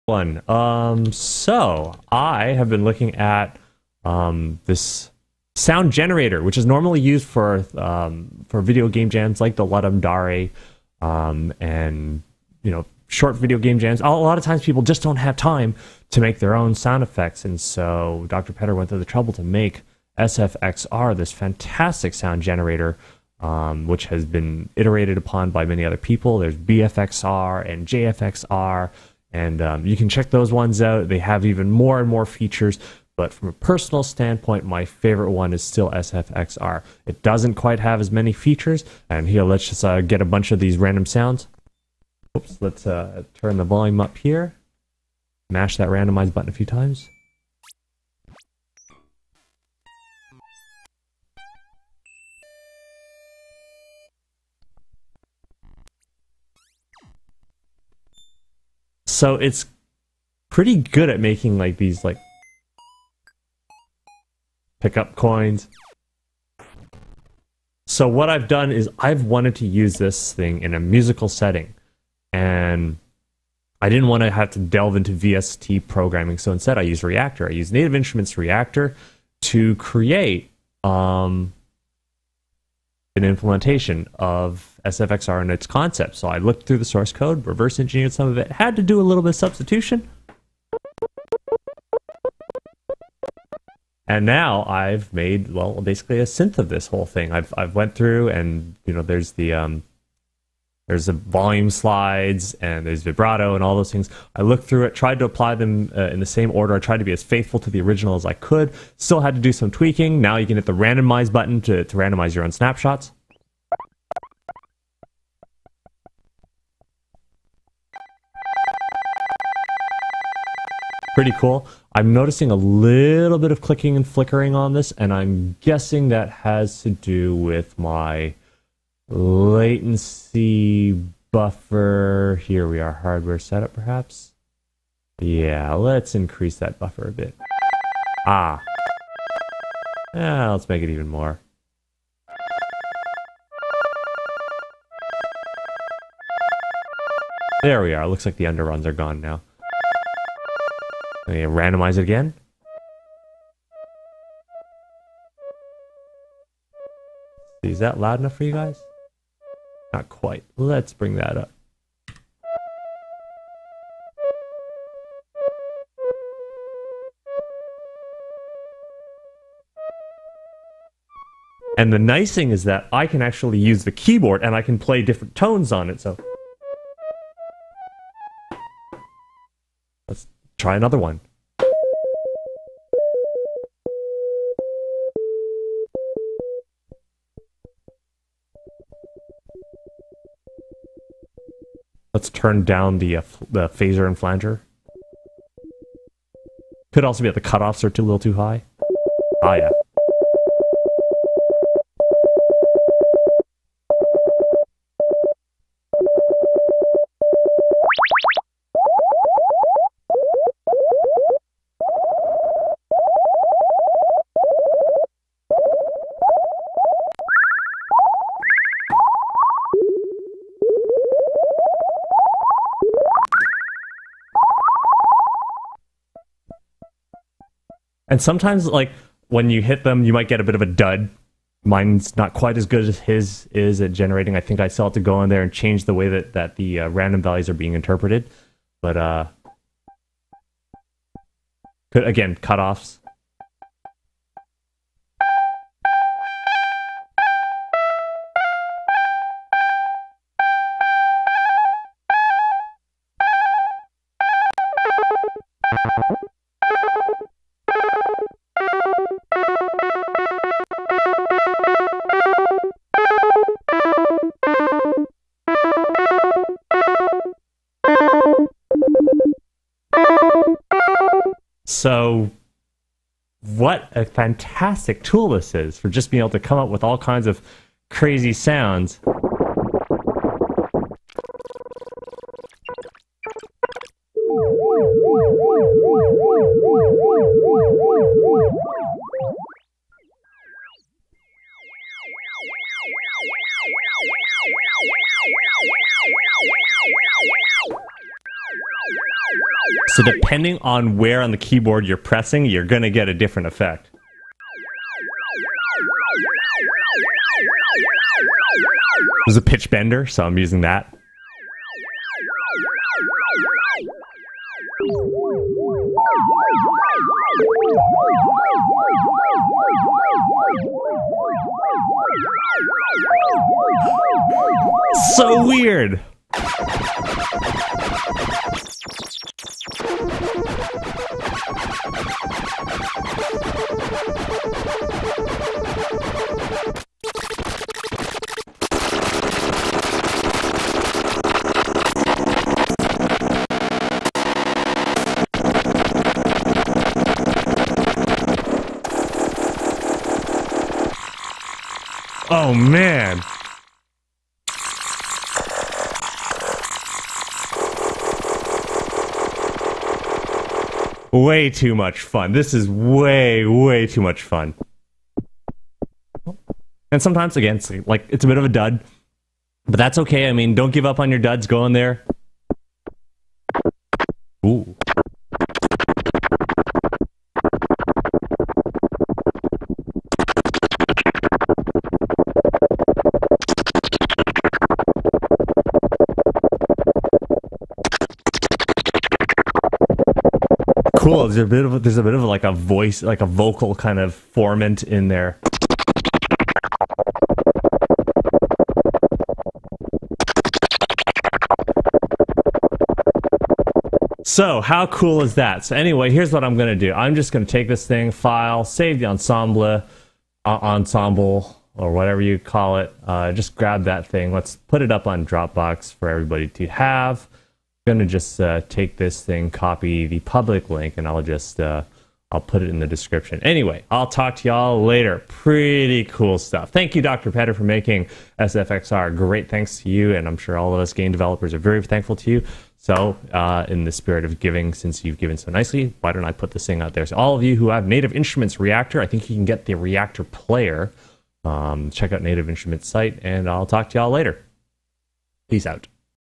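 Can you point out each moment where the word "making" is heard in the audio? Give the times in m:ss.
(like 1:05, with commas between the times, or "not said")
1:01, 7:07.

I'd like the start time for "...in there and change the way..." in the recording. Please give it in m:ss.
3:55.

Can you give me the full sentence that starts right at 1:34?
And now I've made, well, basically a synth of this whole thing.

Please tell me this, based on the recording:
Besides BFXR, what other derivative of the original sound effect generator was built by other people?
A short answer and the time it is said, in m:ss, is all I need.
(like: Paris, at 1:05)
JFXR, at 0:27.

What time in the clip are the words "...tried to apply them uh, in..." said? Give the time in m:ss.
1:44.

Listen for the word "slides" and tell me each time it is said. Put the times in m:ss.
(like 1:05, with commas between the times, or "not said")
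1:41.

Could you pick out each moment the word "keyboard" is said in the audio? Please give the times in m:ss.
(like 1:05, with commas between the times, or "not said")
2:53, 5:01.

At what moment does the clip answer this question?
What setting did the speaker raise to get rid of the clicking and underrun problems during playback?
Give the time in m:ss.
2:09.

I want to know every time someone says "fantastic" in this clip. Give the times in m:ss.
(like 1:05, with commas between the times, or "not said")
0:21, 4:34.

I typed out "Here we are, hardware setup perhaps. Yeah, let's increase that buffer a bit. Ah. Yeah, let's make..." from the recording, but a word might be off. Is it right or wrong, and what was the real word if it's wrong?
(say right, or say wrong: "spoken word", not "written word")
right.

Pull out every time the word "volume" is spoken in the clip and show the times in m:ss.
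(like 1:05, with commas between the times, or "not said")
0:43, 1:41.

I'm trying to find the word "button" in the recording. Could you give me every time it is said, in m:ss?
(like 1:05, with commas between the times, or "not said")
0:46, 1:51.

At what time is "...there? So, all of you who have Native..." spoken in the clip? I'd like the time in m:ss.
7:16.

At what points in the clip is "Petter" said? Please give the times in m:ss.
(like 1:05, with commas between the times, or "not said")
0:18, 7:07.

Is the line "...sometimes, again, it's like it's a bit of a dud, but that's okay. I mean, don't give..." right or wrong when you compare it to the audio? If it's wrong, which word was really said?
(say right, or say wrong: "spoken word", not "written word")
right.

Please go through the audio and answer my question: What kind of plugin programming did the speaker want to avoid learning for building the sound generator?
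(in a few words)
VST programming.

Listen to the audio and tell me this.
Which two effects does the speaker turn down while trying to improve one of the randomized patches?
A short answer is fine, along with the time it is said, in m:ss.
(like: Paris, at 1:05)
phaser and flanger, at 3:13.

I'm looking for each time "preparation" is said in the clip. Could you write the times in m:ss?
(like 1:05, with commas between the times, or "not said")
not said.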